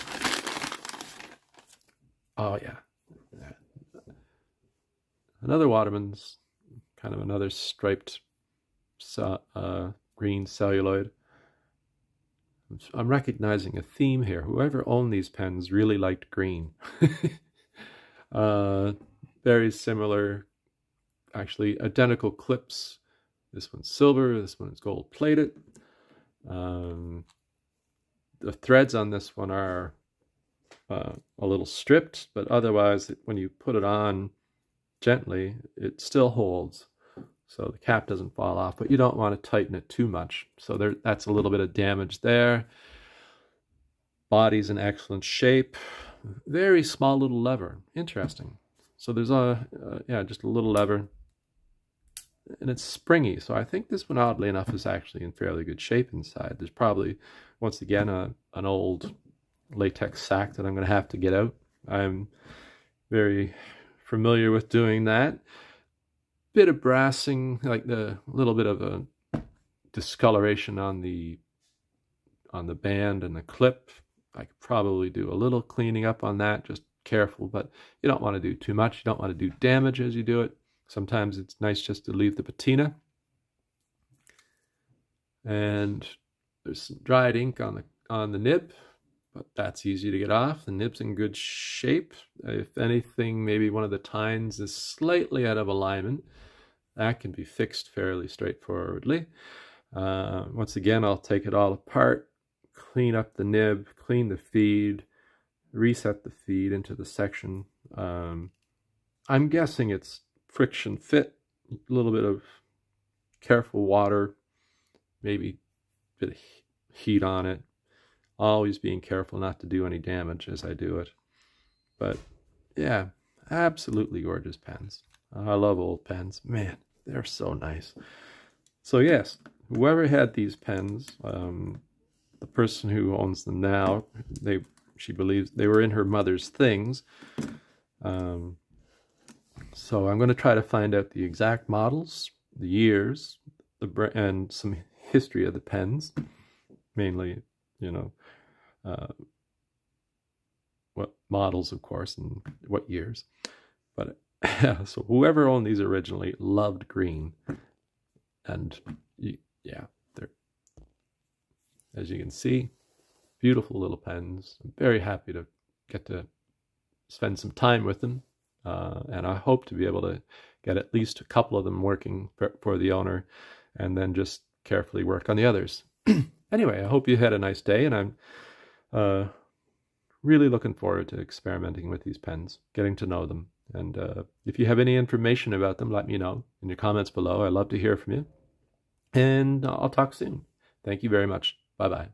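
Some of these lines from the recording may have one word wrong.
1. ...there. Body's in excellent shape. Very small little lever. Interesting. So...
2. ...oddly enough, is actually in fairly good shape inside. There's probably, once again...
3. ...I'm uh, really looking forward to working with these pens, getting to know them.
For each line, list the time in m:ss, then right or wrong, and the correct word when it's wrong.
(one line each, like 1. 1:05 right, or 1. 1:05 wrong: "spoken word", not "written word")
1. 0:42 right
2. 0:54 right
3. 2:57 wrong: "experimenting", not "working".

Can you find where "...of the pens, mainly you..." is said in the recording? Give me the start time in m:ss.
2:25.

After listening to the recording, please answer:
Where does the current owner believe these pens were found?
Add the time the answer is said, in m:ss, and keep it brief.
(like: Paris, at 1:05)
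In her mother's things, at 2:15.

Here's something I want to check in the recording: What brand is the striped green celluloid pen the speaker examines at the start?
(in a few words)
Waterman's.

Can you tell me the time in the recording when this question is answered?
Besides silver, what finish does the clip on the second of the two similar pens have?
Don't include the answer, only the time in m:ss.
0:24.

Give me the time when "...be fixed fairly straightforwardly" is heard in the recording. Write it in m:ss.
1:37.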